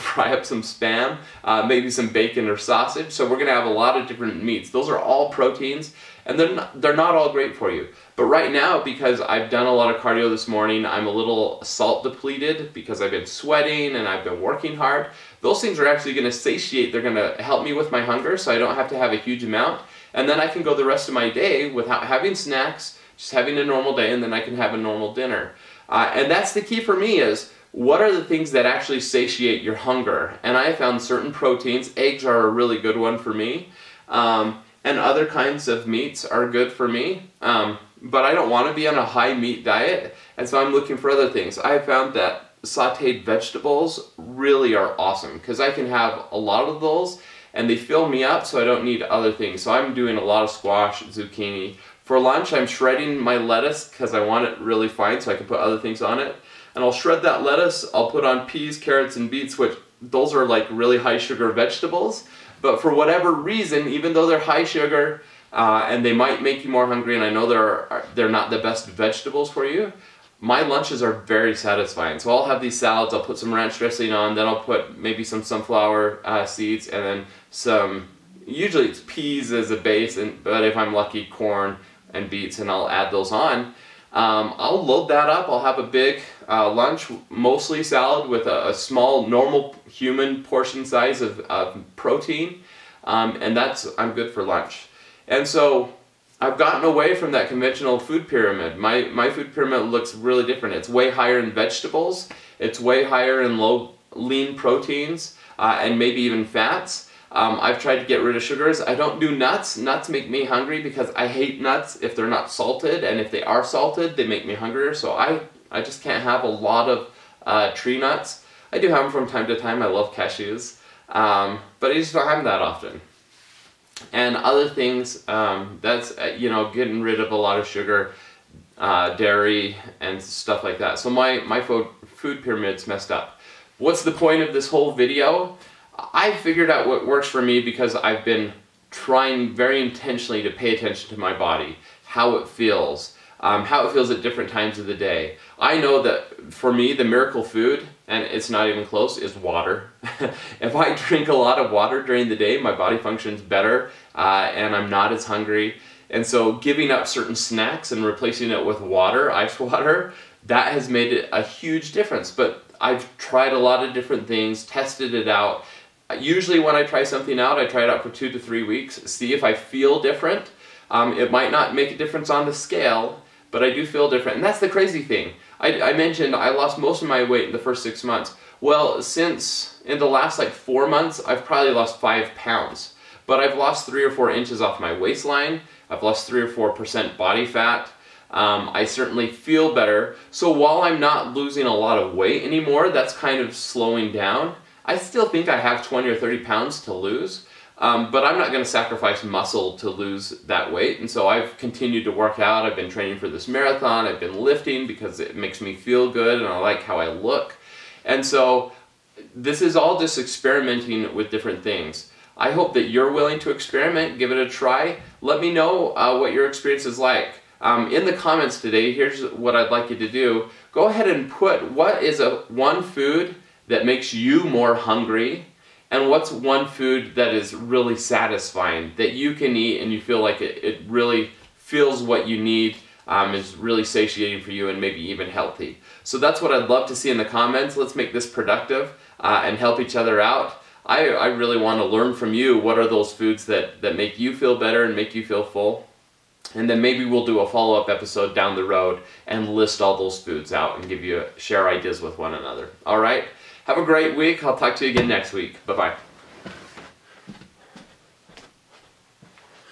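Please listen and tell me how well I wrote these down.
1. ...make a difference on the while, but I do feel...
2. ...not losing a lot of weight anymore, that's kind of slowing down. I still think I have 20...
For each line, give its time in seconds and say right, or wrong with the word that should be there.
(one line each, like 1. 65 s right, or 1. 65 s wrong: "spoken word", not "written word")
1. 171 s wrong: "scale", not "while"
2. 190 s right.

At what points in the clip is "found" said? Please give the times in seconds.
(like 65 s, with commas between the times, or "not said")
30 s, 41 s.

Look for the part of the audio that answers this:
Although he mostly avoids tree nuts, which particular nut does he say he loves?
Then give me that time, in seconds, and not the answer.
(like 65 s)
120 s.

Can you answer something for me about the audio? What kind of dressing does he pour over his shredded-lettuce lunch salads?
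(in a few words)
ranch.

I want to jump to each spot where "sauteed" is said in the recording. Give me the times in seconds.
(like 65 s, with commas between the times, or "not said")
42 s.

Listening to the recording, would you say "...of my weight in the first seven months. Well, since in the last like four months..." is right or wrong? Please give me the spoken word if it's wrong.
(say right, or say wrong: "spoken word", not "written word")
wrong: "six", not "seven".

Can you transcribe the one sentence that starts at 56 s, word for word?
And I'll shred that lettuce, I'll put on peas, carrots, and beets, which those are like really high sugar vegetables.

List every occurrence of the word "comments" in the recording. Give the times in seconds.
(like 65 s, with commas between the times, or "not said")
218 s, 237 s.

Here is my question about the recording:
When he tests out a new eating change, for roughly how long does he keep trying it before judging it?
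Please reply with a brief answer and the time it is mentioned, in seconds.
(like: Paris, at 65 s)
2 to 3 weeks, at 168 s.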